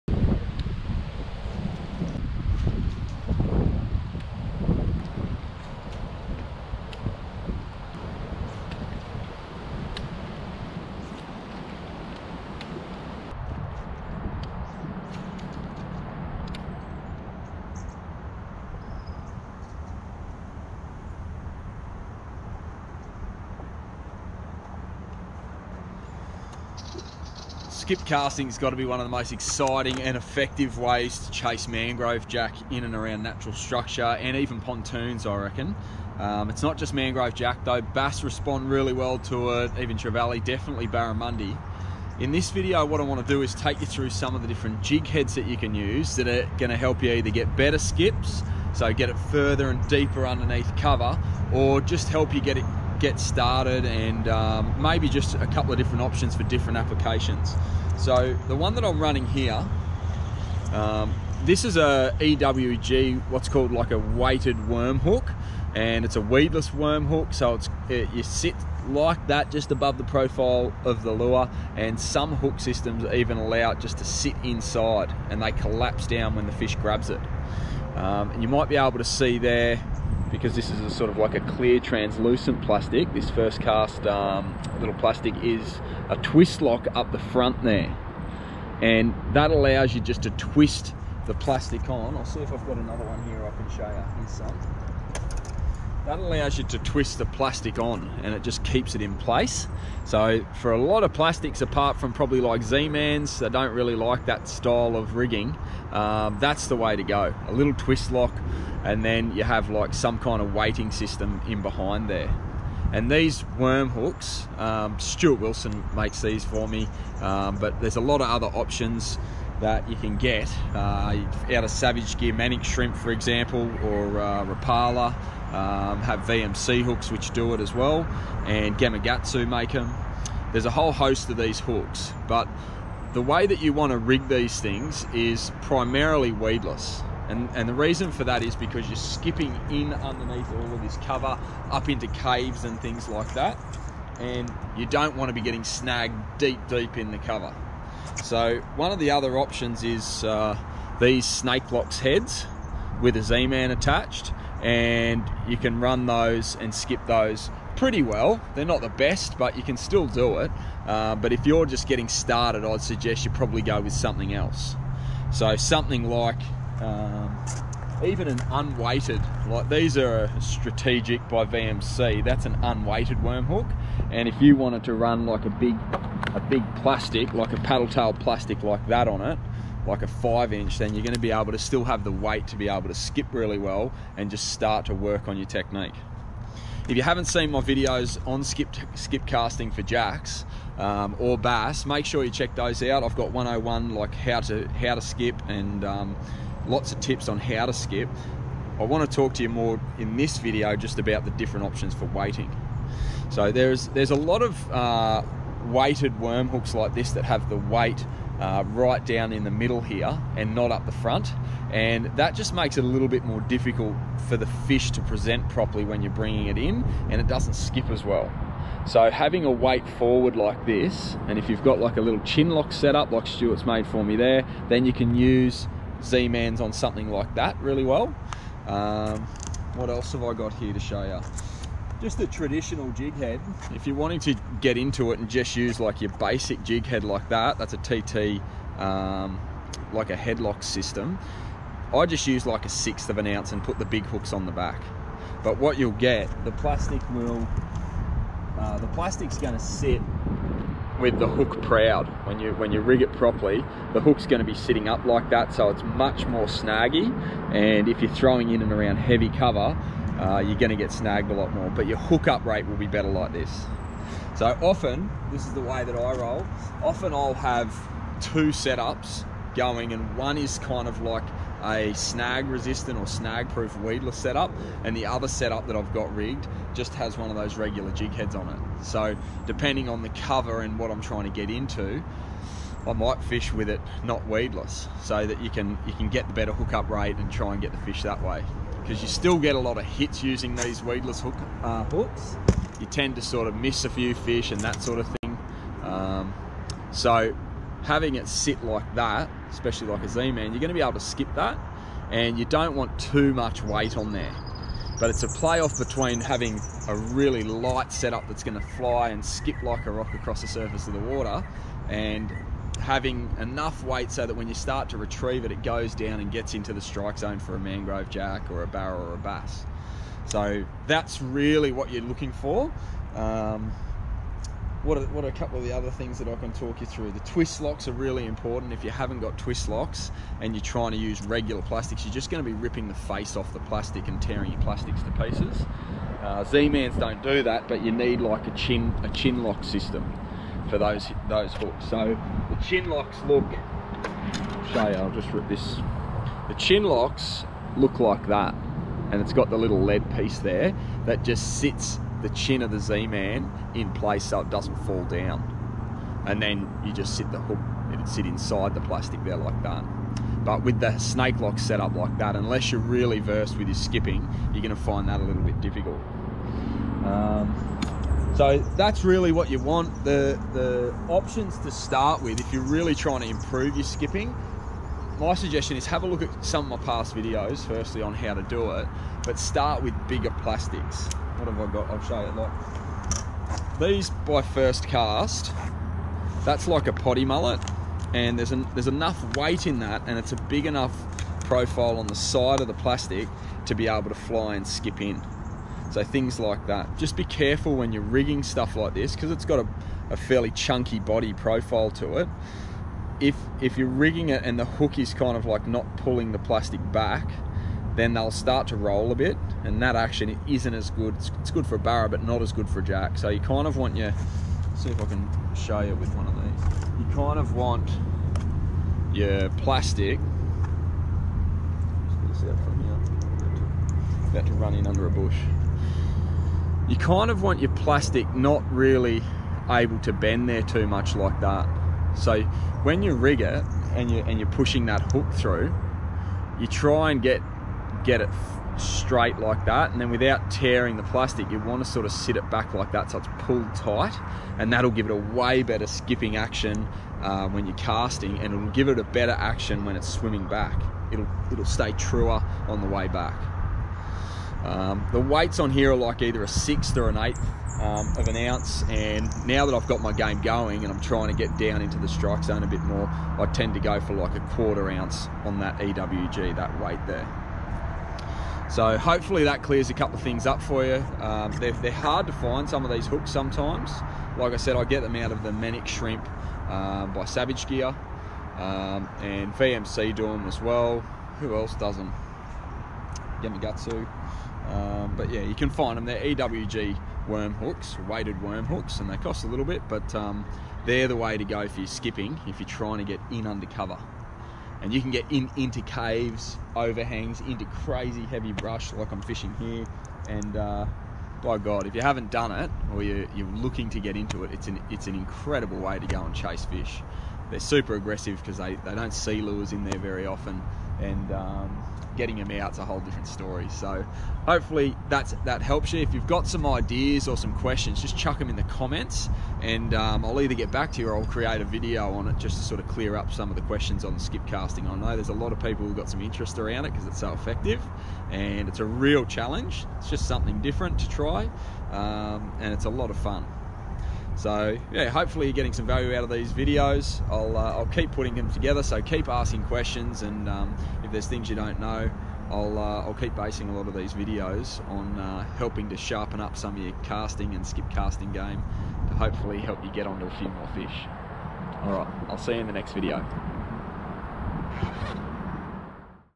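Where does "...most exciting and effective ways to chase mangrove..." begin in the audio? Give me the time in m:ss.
0:29.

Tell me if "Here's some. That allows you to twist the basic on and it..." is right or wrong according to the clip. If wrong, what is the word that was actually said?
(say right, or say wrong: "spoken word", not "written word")
wrong: "plastic", not "basic".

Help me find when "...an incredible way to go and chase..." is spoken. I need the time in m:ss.
8:25.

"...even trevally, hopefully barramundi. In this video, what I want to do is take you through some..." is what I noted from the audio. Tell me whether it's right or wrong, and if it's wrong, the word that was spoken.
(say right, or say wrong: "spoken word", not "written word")
wrong: "definitely", not "hopefully".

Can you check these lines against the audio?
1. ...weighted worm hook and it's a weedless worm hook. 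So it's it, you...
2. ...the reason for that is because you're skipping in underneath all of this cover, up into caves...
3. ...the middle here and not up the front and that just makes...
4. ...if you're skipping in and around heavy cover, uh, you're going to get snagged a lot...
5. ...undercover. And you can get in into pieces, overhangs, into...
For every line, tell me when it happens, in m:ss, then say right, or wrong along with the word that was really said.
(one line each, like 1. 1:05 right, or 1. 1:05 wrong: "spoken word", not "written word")
1. 1:03 right
2. 2:17 right
3. 3:29 right
4. 4:17 wrong: "throwing", not "skipping"
5. 8:13 wrong: "caves", not "pieces".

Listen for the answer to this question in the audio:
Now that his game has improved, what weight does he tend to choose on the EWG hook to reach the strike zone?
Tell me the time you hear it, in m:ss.
7:44.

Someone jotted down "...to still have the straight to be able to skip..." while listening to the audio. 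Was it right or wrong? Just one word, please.
wrong.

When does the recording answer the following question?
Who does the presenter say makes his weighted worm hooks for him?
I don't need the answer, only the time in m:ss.
1:54.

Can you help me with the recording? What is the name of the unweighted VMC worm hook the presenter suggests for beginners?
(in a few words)
Strategic.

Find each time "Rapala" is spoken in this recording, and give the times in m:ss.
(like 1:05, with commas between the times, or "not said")
2:04.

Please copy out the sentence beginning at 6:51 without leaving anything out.
It's, it's good for a barra but not as good for a jack.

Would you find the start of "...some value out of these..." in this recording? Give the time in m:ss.
8:55.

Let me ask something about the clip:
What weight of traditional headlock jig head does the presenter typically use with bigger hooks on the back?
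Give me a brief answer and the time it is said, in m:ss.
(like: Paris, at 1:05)
1/6 ounce, at 4:02.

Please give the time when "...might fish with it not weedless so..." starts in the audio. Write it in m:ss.
4:42.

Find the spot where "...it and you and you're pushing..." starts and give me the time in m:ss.
7:13.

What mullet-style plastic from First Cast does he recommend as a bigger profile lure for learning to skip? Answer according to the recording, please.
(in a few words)
Potty mullet.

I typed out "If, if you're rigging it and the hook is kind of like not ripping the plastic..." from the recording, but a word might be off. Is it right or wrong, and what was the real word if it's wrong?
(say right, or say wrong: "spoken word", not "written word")
wrong: "pulling", not "ripping".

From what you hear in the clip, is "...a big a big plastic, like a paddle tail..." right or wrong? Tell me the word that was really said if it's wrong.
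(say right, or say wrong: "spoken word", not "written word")
right.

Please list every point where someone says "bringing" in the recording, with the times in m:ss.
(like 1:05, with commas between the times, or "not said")
3:36.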